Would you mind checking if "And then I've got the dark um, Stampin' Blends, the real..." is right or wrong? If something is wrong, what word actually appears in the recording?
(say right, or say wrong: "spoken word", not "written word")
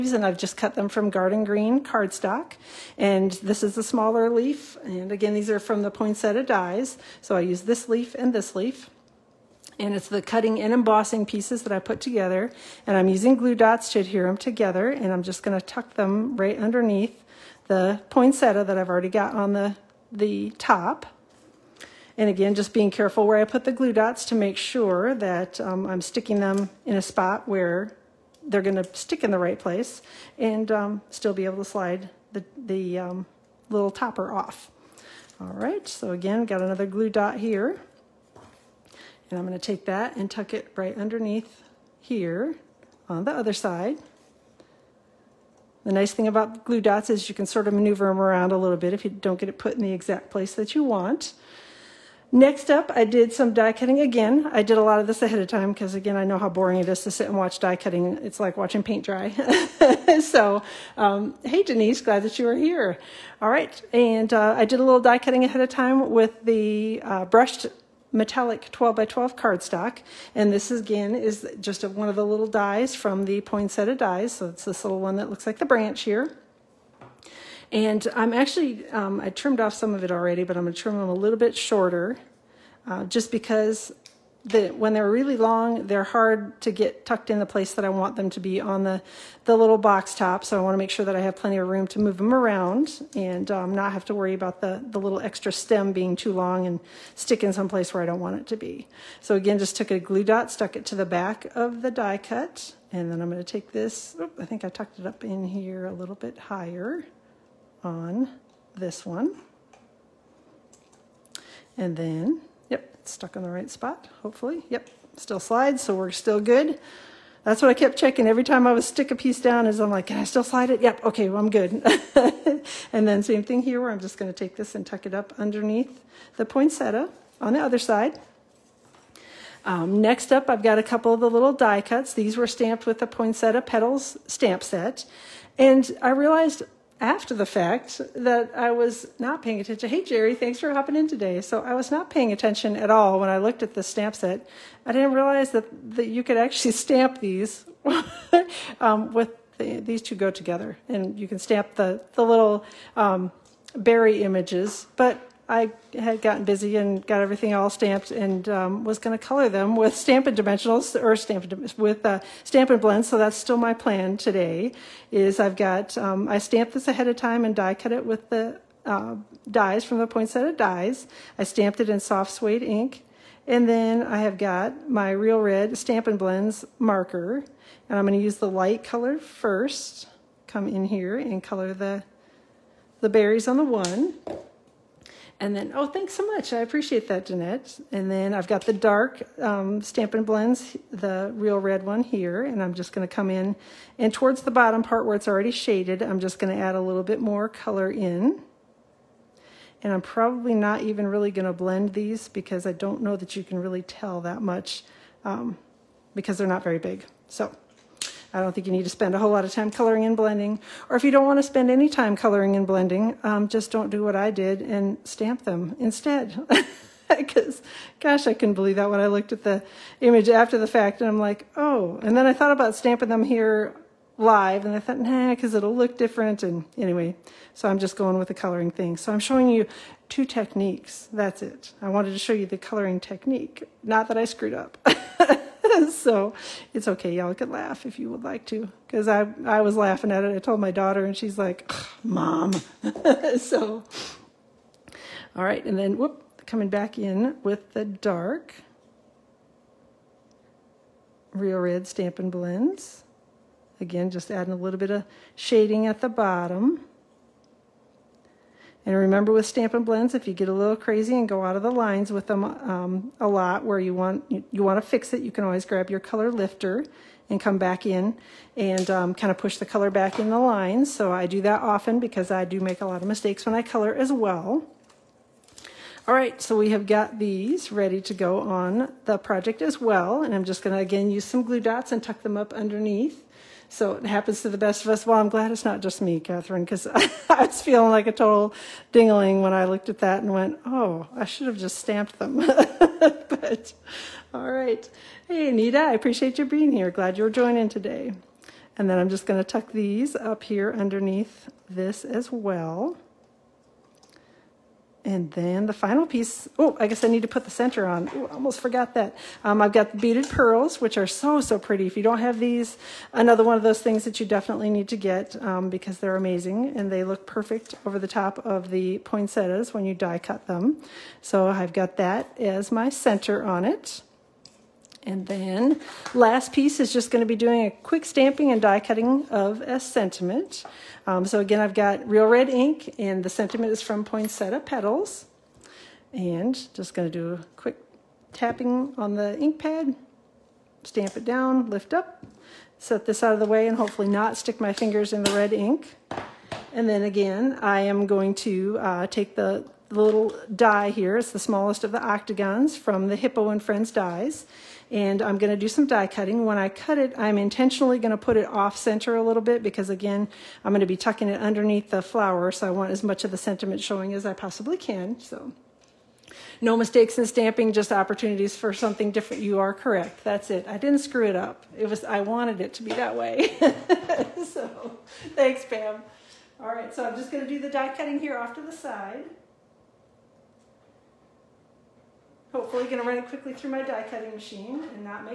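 right.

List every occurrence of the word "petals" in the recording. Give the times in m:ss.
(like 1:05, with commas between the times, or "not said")
2:13, 5:34.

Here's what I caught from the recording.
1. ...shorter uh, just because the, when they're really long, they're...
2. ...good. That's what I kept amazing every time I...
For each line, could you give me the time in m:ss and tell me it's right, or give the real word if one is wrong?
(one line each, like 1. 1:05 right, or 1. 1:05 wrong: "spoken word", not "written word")
1. 1:21 right
2. 1:56 wrong: "checking", not "amazing".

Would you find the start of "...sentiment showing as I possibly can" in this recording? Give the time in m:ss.
6:03.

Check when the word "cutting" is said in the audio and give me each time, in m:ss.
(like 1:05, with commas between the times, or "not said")
0:10, 0:53, 0:57, 1:05, 5:28, 5:56, 6:17, 6:24.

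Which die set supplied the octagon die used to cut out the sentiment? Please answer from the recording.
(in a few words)
Hippo and Friends.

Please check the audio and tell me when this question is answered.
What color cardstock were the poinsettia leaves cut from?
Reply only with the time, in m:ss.
0:01.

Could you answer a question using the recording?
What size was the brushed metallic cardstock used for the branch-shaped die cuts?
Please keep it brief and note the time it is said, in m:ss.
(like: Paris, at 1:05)
12 by 12, at 1:08.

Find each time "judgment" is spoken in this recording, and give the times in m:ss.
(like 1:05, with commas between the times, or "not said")
not said.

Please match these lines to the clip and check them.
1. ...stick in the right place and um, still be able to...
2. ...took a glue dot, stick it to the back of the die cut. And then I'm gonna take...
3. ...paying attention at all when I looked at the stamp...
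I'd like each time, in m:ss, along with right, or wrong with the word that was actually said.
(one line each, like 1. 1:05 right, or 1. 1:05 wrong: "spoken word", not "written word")
1. 0:28 right
2. 1:39 wrong: "stuck", not "stick"
3. 2:22 right.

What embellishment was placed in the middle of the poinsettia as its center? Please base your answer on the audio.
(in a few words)
Beaded pearls.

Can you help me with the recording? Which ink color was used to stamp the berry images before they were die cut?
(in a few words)
Soft suede.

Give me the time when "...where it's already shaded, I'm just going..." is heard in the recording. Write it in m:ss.
3:15.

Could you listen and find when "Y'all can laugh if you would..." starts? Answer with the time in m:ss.
3:57.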